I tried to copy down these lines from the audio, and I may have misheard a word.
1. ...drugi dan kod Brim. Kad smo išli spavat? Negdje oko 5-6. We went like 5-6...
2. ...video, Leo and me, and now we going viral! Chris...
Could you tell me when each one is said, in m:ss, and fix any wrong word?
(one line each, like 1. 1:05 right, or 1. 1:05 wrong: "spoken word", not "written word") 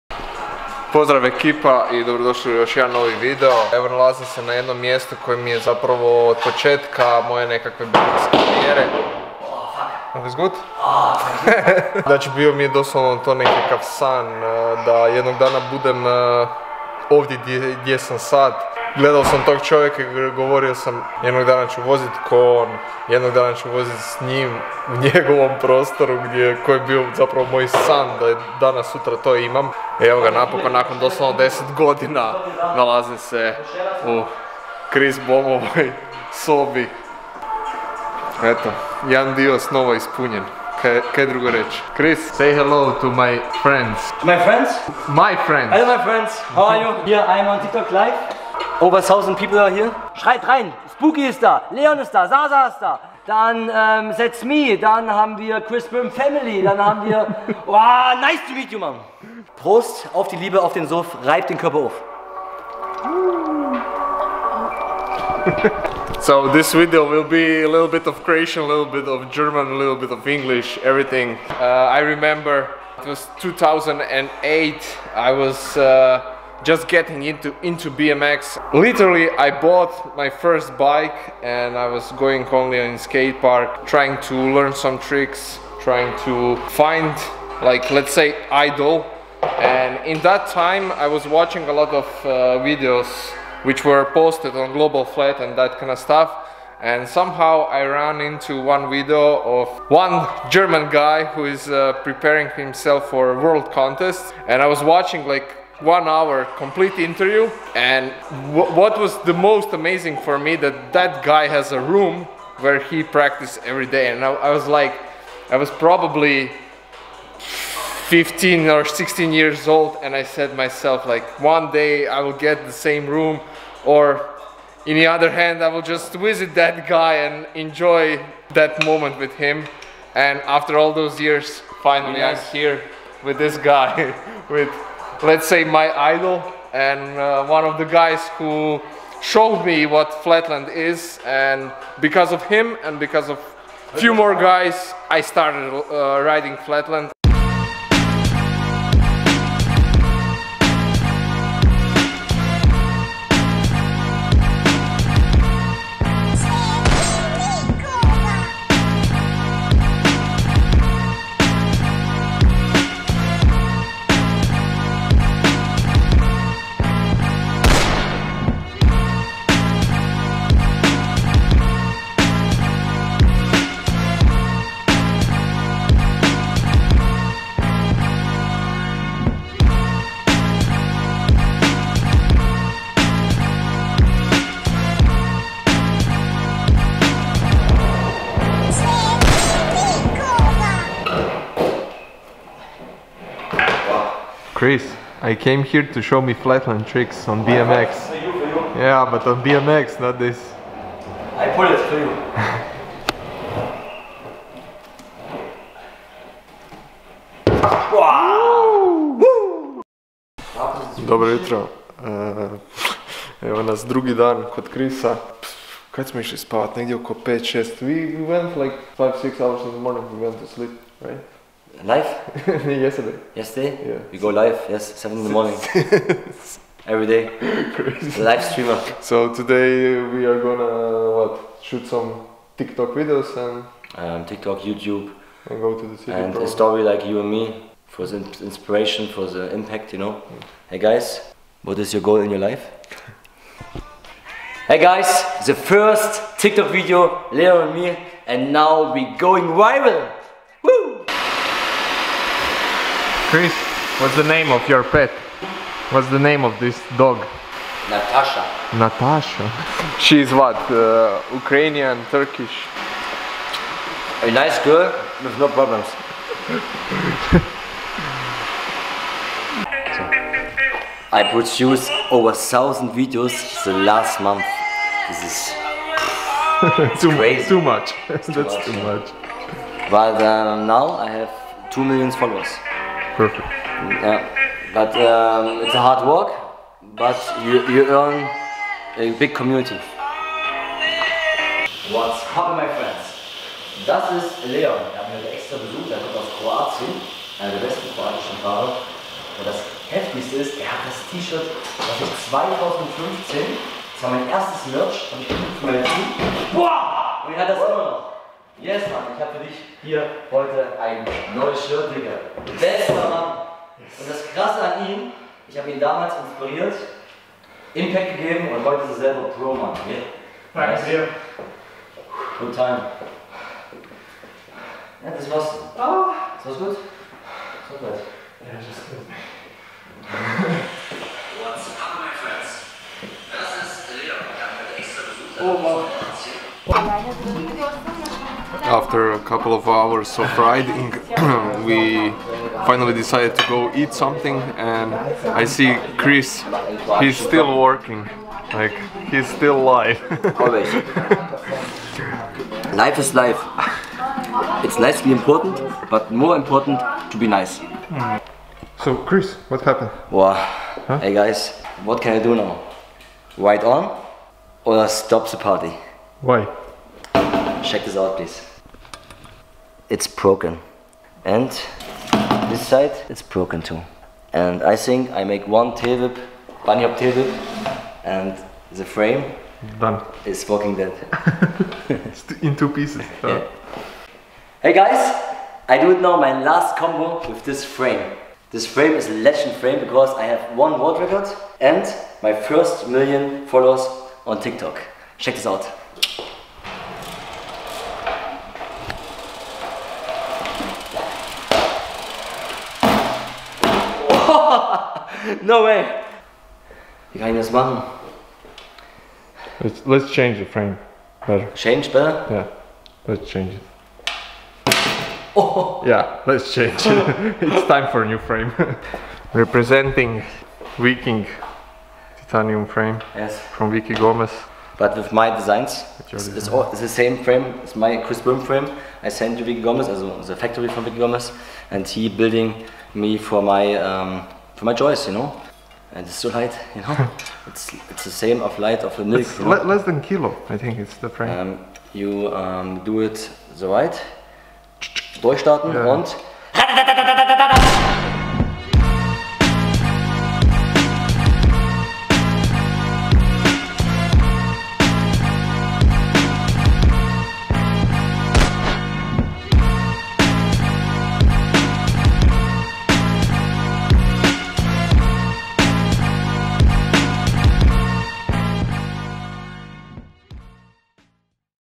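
1. 3:33 wrong: "Krisa", not "Brim"
2. 4:06 right.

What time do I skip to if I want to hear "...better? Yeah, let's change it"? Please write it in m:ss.
6:51.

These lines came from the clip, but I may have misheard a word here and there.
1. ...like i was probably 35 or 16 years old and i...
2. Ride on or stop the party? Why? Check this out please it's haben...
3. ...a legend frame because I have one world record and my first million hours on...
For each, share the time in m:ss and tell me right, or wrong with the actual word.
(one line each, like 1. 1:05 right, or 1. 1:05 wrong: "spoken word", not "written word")
1. 1:54 wrong: "15", not "35"
2. 6:03 wrong: "broken", not "haben"
3. 6:29 wrong: "followers", not "hours".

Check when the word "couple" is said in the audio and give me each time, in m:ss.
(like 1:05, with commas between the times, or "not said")
5:39.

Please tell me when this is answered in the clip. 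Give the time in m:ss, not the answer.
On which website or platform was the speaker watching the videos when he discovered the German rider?
1:34.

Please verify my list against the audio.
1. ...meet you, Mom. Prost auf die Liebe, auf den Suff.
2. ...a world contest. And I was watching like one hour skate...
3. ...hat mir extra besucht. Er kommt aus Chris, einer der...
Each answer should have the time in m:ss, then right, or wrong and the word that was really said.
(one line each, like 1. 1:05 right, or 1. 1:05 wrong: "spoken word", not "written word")
1. 0:58 right
2. 1:43 wrong: "complete", not "skate"
3. 4:55 wrong: "Kroatien", not "Chris".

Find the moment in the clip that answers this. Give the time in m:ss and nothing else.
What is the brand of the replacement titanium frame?
7:00.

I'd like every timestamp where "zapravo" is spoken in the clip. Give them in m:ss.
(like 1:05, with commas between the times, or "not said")
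0:05, 0:27.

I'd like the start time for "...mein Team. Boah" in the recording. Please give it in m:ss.
5:05.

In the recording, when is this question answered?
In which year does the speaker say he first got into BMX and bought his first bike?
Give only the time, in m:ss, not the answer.
1:13.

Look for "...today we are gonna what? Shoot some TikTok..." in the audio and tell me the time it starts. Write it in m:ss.
3:49.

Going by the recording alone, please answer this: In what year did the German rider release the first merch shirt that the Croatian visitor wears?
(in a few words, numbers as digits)
2015.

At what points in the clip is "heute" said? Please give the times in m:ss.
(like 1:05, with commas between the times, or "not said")
5:10, 5:18.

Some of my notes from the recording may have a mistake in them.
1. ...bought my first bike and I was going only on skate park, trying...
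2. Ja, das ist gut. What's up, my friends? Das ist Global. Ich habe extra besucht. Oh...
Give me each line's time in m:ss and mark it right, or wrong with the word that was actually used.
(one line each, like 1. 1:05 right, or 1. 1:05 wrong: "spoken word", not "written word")
1. 1:19 right
2. 5:28 wrong: "Leon", not "Global".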